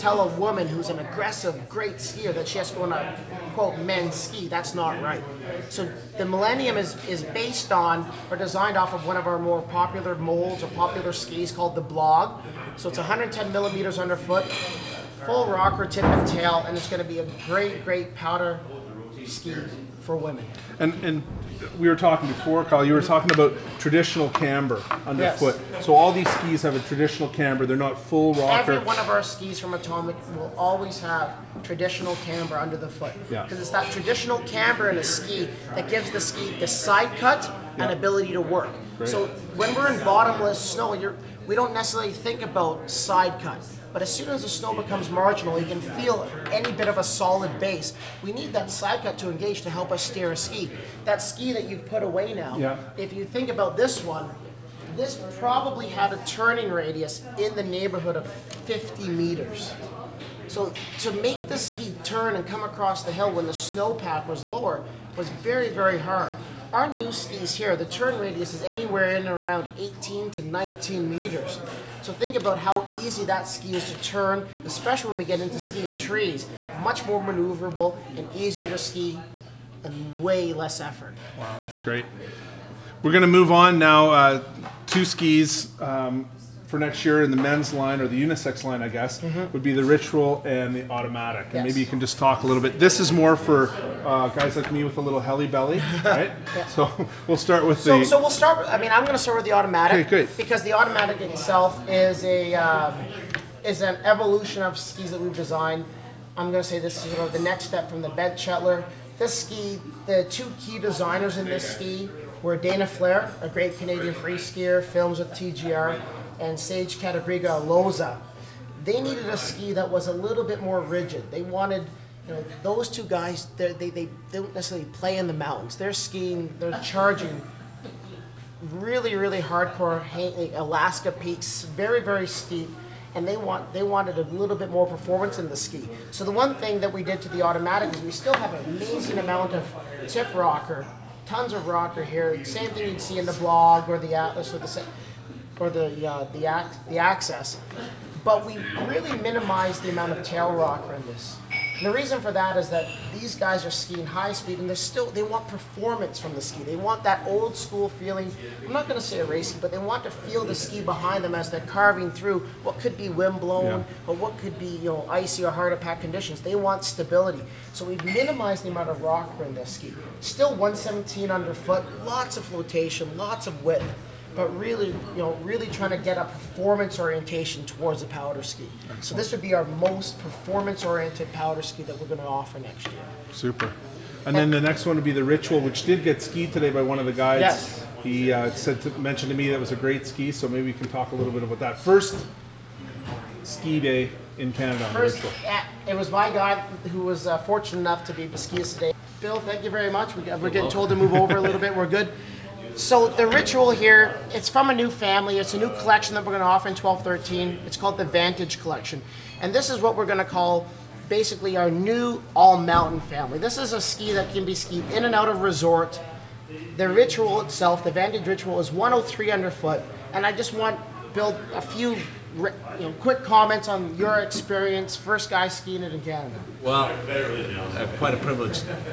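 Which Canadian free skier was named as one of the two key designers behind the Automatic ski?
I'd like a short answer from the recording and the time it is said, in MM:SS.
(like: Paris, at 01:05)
Dana Flahr, at 01:52.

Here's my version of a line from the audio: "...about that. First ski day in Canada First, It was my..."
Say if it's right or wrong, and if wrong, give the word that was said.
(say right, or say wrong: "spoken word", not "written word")
right.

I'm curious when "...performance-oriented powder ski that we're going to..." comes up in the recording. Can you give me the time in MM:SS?
03:00.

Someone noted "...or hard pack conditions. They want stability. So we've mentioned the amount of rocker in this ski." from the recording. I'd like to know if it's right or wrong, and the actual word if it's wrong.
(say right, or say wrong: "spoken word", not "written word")
wrong: "minimized", not "mentioned".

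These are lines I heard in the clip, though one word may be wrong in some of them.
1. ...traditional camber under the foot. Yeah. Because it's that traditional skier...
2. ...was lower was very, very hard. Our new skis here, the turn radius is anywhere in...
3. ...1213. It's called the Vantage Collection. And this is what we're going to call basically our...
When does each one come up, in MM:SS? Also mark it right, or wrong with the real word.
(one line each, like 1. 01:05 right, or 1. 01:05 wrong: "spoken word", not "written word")
1. 00:31 wrong: "camber", not "skier"
2. 01:04 right
3. 03:26 right.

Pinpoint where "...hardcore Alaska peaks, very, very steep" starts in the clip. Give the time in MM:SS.
02:09.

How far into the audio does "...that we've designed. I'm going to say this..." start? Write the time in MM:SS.
01:45.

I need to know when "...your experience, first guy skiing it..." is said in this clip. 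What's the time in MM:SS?
03:43.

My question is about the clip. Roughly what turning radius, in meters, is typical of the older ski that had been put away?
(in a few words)
50 meters.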